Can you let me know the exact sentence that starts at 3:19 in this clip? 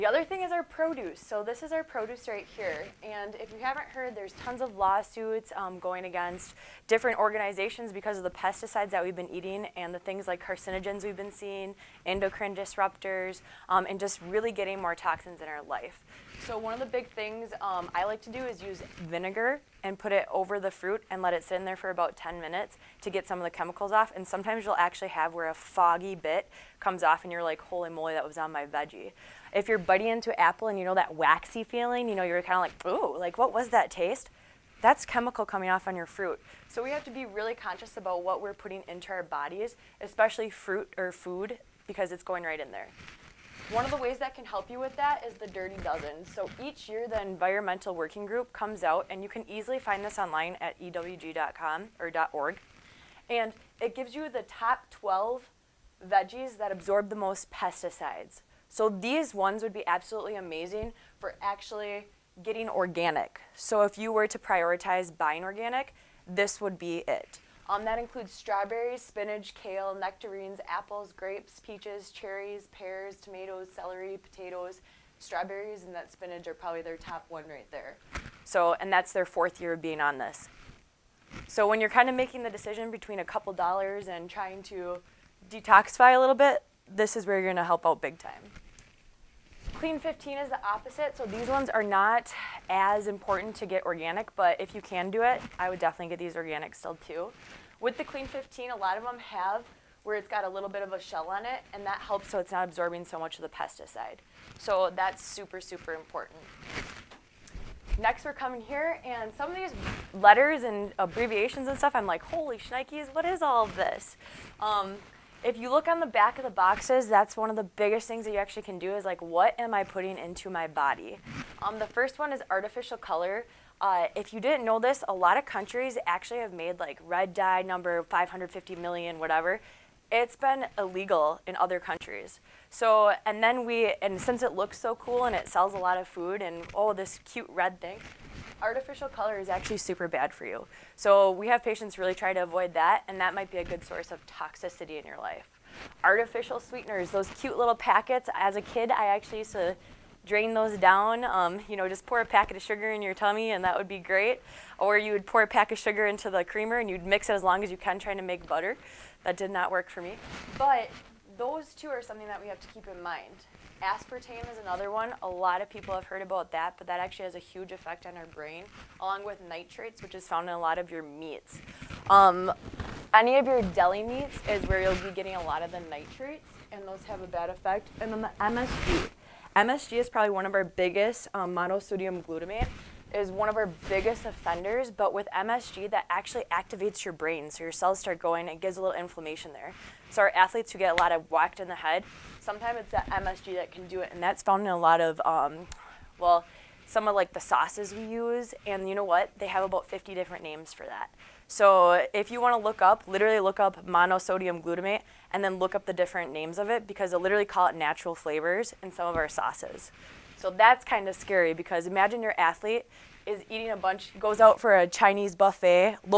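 They have about 50 different names for that.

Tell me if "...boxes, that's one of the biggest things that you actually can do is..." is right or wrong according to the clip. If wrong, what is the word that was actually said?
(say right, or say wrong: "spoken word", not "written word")
right.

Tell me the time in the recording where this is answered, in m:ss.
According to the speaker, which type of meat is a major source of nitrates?
2:53.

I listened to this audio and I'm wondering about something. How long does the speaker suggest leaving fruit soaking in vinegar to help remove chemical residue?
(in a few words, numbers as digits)
10 minutes.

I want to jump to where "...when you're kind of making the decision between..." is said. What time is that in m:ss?
1:21.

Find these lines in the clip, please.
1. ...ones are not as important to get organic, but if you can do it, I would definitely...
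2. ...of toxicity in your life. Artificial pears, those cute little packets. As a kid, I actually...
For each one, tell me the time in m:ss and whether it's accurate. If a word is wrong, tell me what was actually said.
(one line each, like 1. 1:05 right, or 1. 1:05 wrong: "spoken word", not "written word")
1. 1:31 right
2. 2:24 wrong: "sweeteners", not "pears".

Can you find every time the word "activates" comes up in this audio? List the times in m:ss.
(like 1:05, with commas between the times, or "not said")
3:06.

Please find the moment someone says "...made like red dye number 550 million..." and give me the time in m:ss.
2:06.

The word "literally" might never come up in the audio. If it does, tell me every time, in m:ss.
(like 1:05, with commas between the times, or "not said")
3:23, 3:27.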